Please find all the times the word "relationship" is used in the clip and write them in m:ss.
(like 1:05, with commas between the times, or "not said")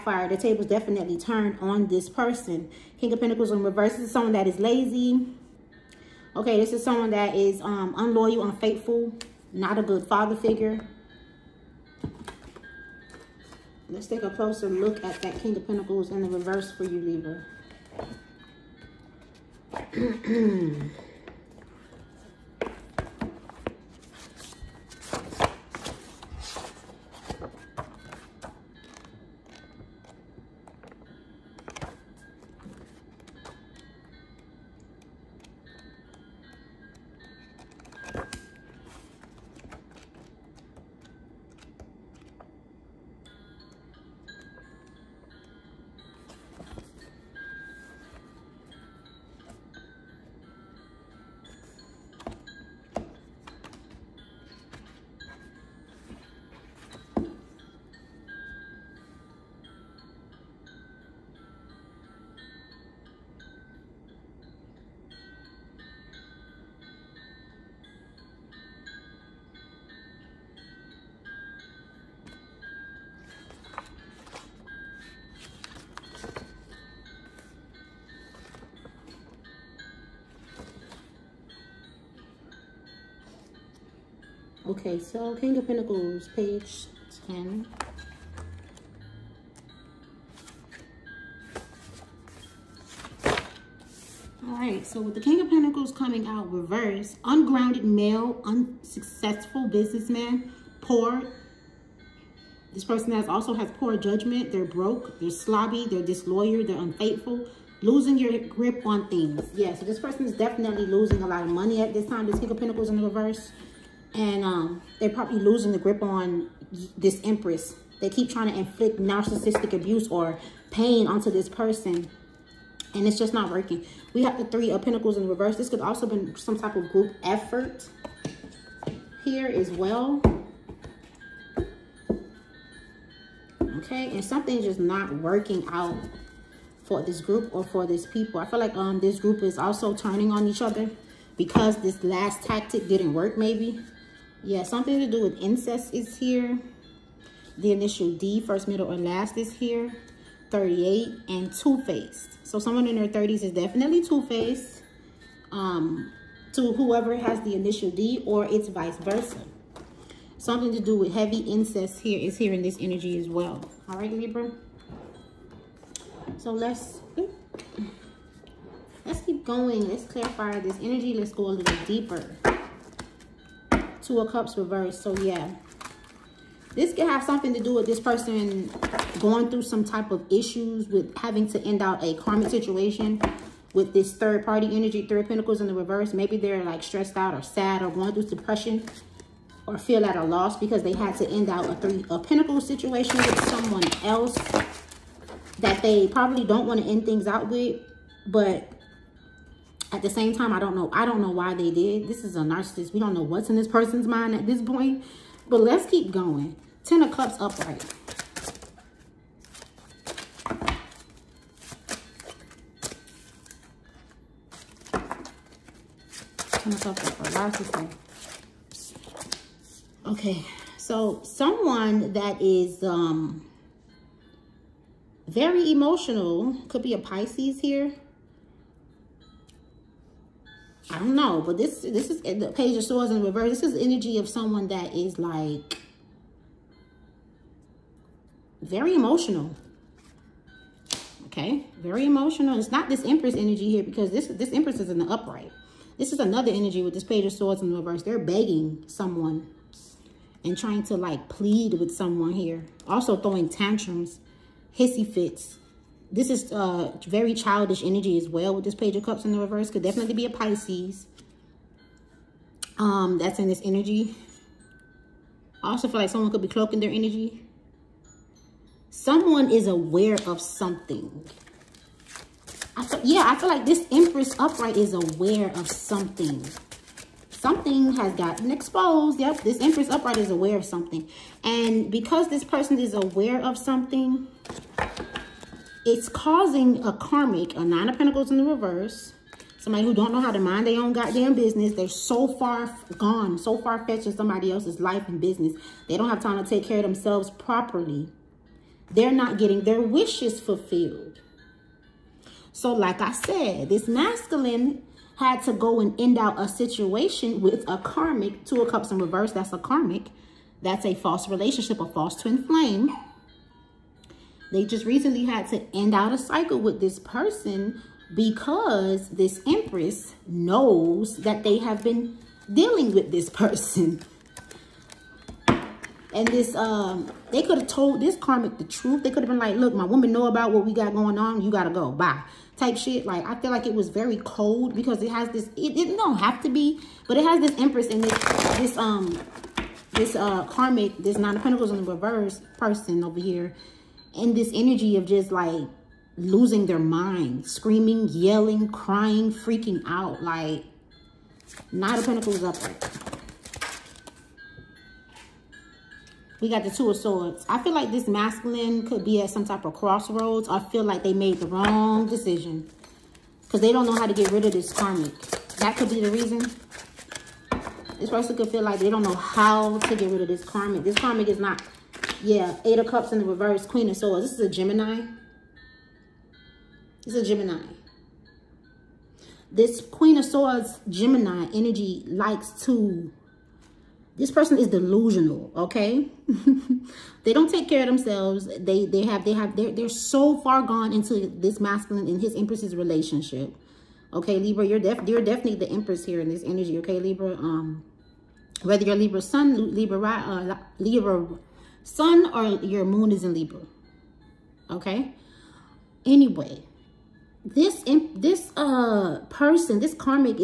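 5:11, 6:32.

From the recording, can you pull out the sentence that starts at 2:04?
We have the three of pentacles in reverse.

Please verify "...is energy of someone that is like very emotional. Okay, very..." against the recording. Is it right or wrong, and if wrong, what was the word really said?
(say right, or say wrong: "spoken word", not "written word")
right.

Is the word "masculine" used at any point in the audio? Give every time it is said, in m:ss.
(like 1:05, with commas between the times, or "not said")
5:03, 5:58, 6:31.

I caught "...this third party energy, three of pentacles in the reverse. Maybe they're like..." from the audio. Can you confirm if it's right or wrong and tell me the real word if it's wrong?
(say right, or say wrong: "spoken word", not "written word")
right.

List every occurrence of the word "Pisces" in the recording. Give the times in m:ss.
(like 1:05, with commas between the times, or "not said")
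3:46, 4:20.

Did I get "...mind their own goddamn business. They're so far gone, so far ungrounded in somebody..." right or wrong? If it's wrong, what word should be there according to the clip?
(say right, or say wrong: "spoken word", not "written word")
wrong: "fetched", not "ungrounded".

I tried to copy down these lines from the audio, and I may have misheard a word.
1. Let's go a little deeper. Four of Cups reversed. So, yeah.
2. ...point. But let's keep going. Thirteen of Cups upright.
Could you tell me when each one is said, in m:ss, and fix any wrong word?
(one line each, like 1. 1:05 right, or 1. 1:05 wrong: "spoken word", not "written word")
1. 2:51 wrong: "Two", not "Four"
2. 3:24 wrong: "Ten", not "Thirteen".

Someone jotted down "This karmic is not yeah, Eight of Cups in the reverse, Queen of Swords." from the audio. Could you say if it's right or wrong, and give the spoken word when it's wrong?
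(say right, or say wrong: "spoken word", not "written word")
right.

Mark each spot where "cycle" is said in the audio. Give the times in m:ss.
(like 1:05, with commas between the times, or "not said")
5:16.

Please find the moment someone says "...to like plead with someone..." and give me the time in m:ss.
4:10.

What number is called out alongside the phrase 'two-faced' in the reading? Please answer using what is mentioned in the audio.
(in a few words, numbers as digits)
38.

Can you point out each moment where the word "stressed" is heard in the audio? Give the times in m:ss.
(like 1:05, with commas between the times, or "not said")
3:06.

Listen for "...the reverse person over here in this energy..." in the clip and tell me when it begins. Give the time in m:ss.
5:41.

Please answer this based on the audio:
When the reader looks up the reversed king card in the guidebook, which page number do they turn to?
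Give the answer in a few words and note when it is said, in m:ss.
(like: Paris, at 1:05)
10, at 1:26.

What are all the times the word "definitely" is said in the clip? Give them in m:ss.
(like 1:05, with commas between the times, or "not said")
0:00, 1:50, 2:33, 4:19, 6:35.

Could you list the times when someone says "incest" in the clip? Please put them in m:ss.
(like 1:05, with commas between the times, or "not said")
2:25, 2:41.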